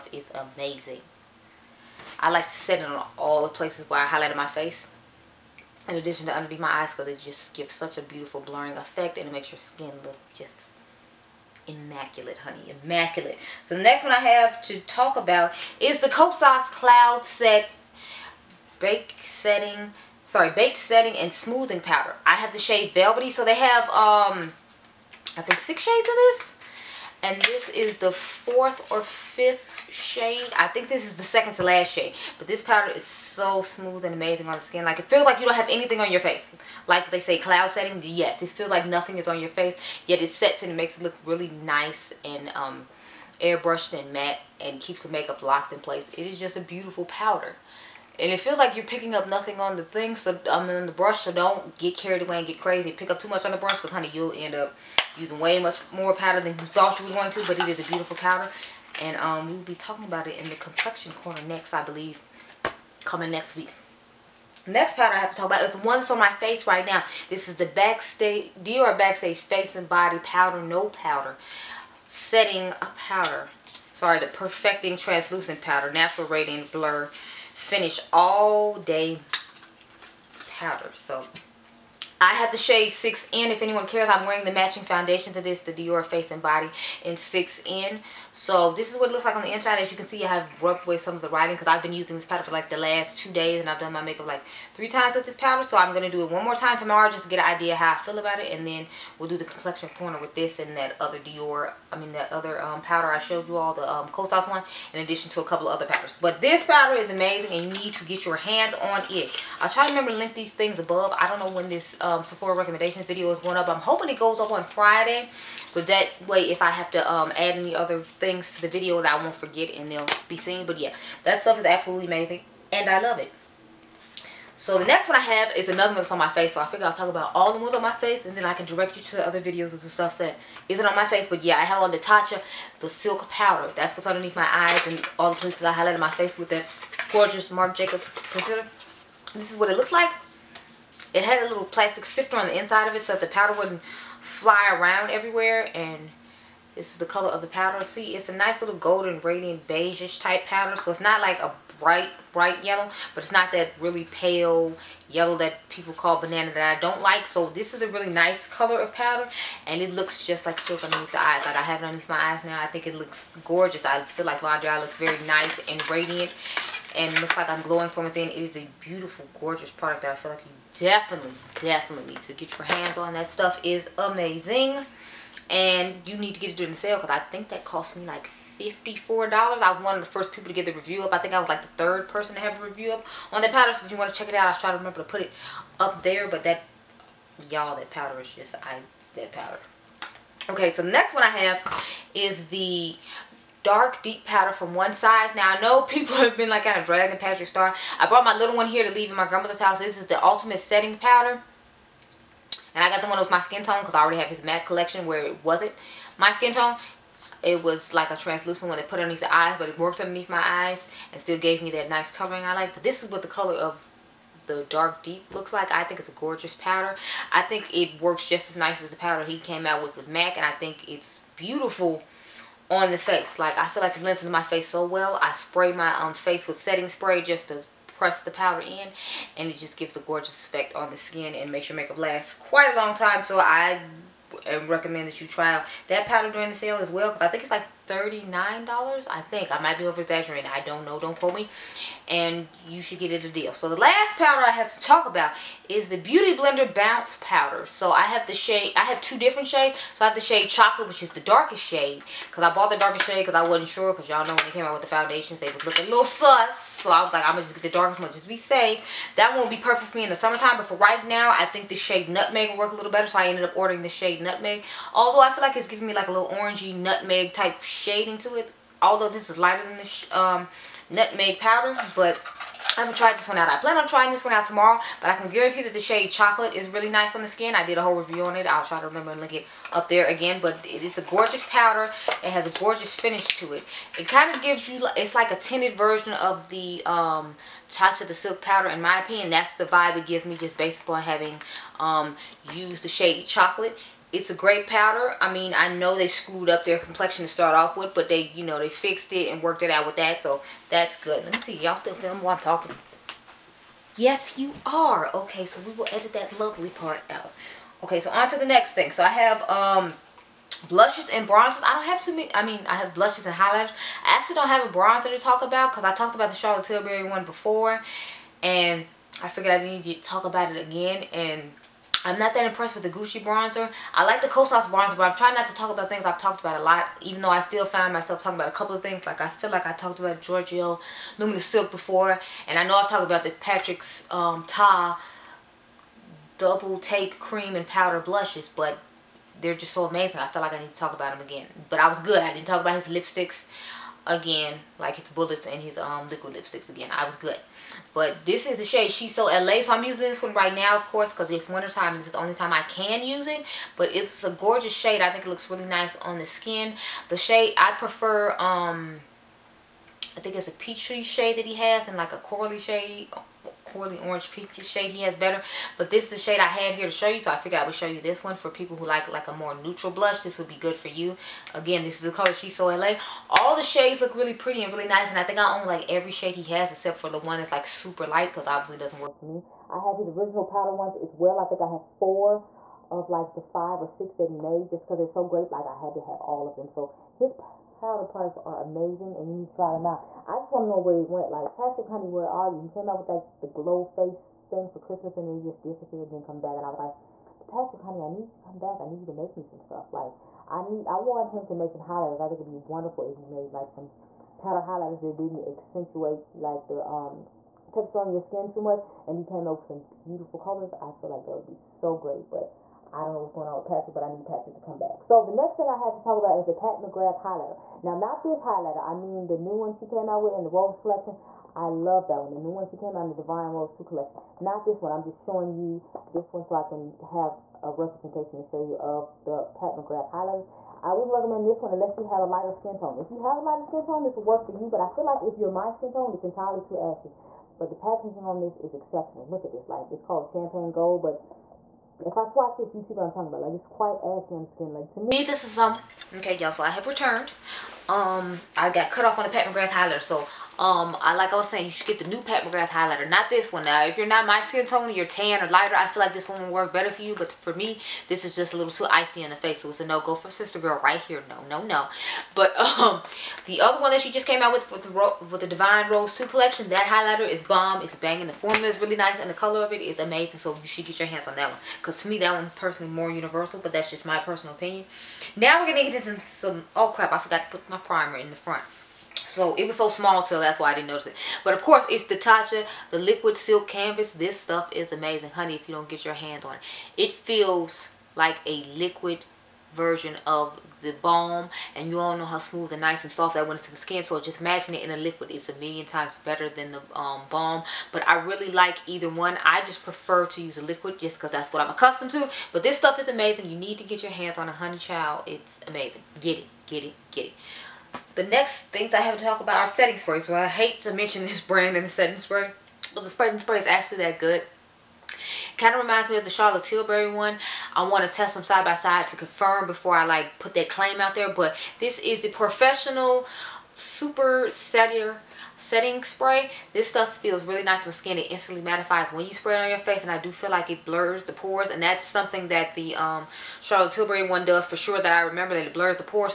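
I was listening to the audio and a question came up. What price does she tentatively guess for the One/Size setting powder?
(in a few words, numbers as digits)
$39.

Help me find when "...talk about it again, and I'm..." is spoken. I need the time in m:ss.
5:20.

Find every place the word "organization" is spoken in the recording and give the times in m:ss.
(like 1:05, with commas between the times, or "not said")
not said.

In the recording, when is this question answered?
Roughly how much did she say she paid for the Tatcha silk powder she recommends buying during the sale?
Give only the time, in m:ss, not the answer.
2:58.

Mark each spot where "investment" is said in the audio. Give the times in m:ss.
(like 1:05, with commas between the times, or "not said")
not said.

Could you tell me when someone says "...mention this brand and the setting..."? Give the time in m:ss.
8:30.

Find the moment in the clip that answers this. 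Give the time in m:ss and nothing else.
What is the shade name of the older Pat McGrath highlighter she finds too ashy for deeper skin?
7:20.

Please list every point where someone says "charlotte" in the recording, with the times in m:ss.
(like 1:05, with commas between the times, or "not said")
5:16, 8:36, 8:53.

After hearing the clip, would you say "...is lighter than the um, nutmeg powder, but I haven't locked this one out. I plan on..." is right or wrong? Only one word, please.
wrong.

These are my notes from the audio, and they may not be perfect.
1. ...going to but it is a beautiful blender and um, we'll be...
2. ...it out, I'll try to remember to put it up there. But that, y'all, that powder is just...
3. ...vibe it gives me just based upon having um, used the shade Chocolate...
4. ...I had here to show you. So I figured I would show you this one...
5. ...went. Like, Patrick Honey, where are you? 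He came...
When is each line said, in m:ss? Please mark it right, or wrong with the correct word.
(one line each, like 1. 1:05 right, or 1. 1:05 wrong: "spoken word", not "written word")
1. 0:57 wrong: "powder", not "blender"
2. 3:04 right
3. 4:49 right
4. 6:06 right
5. 6:31 right.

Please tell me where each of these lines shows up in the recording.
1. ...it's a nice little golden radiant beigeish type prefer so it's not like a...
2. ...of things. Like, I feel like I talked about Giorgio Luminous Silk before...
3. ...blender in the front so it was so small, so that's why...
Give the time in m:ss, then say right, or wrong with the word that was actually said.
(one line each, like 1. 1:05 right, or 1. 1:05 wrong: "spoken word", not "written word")
1. 2:28 wrong: "powder", not "prefer"
2. 5:28 right
3. 7:57 wrong: "primer", not "blender".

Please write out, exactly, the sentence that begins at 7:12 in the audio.
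If you have a lighter skin tone, this will work for you.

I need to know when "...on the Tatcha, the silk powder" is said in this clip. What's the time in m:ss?
2:11.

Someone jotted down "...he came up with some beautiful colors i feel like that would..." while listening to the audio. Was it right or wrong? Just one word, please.
right.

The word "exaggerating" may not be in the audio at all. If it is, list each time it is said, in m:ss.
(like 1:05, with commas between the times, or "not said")
4:00.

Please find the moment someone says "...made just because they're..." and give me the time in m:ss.
6:24.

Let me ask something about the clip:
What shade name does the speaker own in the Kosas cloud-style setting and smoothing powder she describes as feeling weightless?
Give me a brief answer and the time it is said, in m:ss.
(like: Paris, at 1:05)
Velvety, at 0:22.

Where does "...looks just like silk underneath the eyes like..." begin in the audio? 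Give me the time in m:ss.
2:39.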